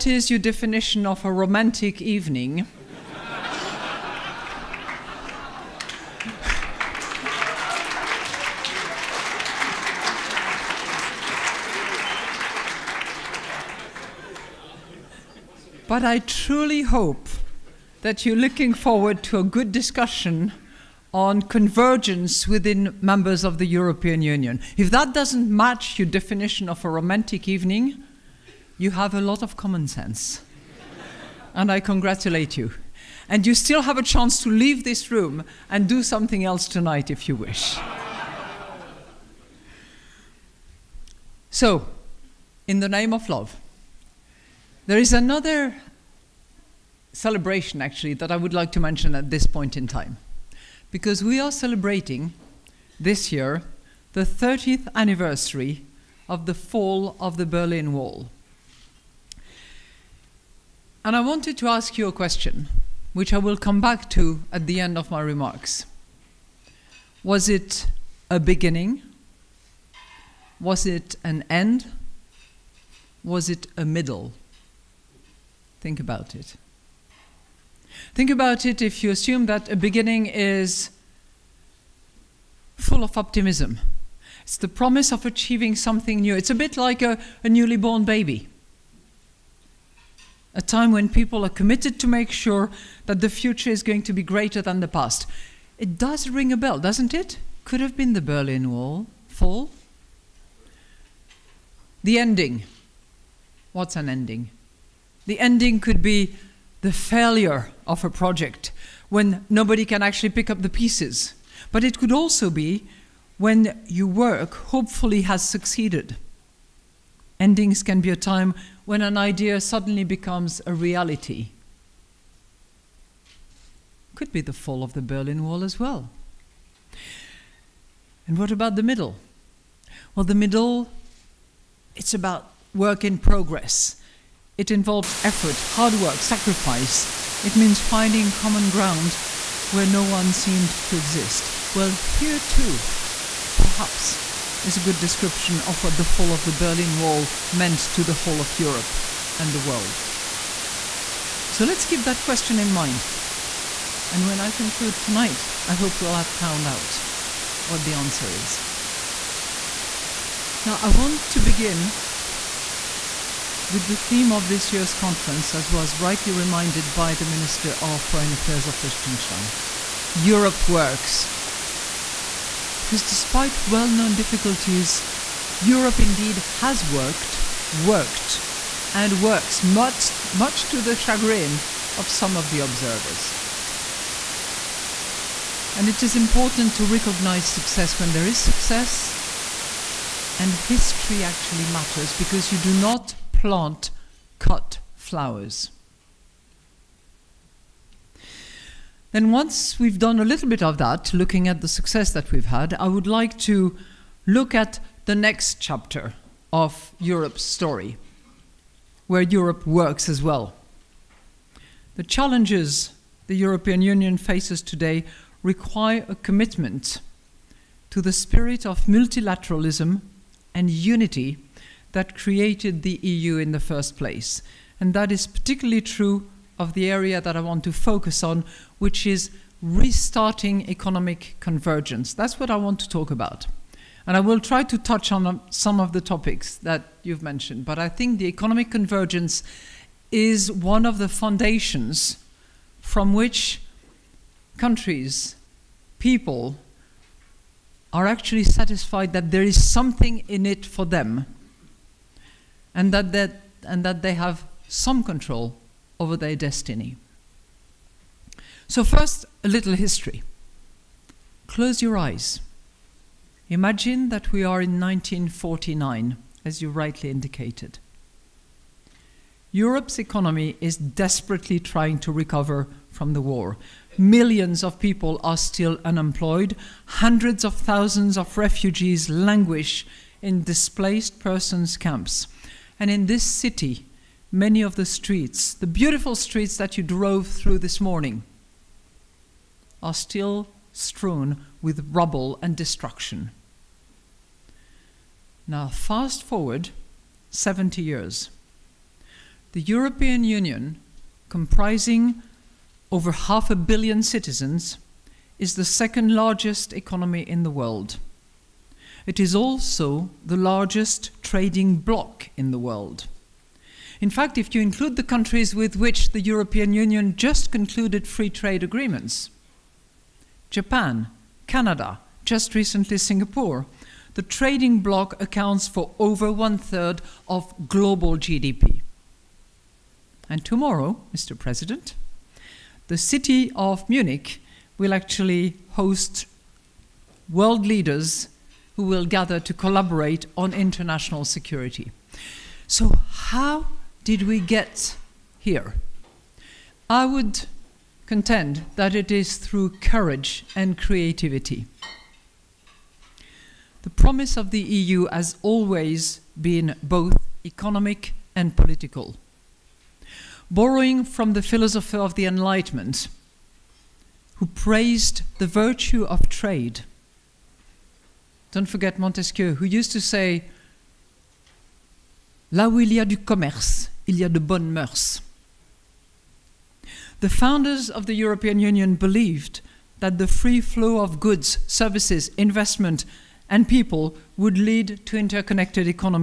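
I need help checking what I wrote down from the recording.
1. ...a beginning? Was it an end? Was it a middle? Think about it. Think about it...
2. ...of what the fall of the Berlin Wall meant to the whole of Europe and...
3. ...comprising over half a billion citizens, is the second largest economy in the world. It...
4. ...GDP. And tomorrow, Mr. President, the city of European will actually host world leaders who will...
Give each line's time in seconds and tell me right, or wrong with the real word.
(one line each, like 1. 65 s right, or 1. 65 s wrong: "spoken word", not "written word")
1. 68 s right
2. 145 s right
3. 301 s right
4. 328 s wrong: "Munich", not "European".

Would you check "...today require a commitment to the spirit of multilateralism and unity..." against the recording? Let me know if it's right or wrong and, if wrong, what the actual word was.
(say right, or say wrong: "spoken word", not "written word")
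right.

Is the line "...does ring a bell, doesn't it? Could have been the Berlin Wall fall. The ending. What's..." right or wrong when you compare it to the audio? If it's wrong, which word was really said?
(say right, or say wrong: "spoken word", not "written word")
right.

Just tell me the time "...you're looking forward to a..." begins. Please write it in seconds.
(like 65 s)
18 s.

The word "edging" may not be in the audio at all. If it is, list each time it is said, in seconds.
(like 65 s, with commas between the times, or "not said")
not said.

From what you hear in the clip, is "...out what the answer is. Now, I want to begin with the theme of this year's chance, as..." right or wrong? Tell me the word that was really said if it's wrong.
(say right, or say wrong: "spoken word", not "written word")
wrong: "conference", not "chance".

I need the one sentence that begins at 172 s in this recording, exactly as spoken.
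Because despite well known difficulties, Europe indeed has worked, worked, and works, much, much to the chagrin of some of the observers.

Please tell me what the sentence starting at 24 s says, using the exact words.
If that doesn't match your definition of a romantic evening, you have a lot of common sense.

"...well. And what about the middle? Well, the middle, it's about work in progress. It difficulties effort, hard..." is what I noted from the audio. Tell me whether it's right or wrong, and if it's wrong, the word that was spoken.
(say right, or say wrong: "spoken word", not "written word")
wrong: "involves", not "difficulties".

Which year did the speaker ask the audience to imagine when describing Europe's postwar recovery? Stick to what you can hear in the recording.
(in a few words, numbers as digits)
1949.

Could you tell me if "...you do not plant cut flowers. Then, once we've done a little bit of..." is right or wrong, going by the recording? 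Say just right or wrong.
right.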